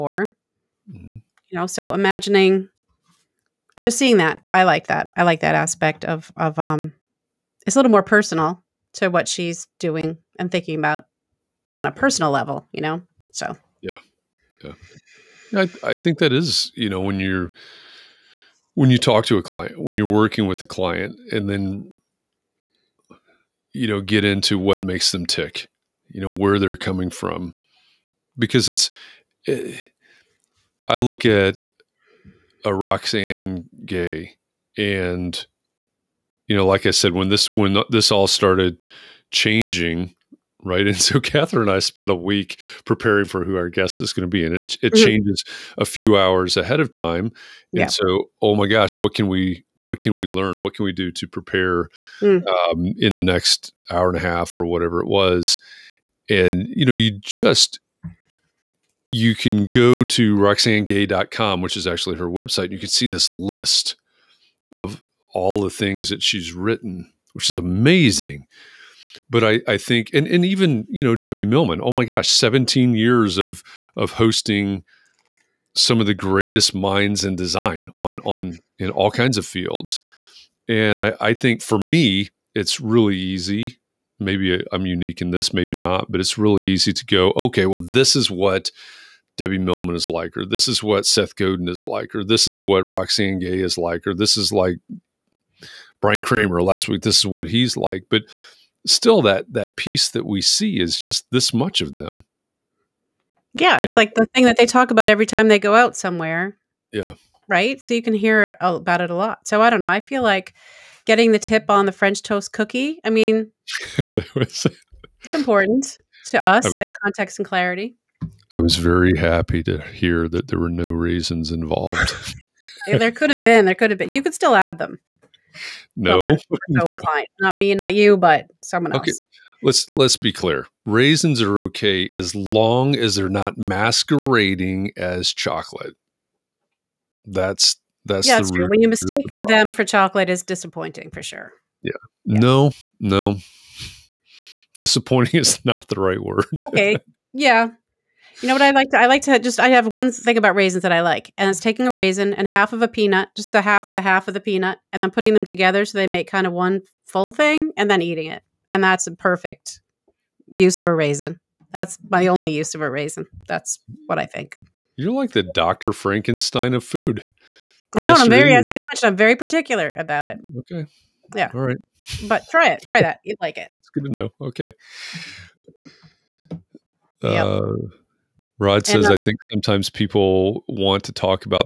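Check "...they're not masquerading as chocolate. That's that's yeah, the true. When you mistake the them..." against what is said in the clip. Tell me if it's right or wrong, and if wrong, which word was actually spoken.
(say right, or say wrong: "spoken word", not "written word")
right.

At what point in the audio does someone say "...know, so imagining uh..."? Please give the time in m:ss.
0:01.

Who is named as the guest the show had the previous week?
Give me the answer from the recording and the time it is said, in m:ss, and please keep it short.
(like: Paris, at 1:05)
Brian Kramer, at 1:35.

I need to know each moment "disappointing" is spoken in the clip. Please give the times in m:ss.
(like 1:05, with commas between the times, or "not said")
2:20, 2:24.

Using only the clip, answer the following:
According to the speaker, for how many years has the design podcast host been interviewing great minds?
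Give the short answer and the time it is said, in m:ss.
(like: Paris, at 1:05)
17, at 1:12.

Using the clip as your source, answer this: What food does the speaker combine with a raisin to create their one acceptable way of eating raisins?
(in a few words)
half of a peanut.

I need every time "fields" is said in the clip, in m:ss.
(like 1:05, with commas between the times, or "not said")
1:19.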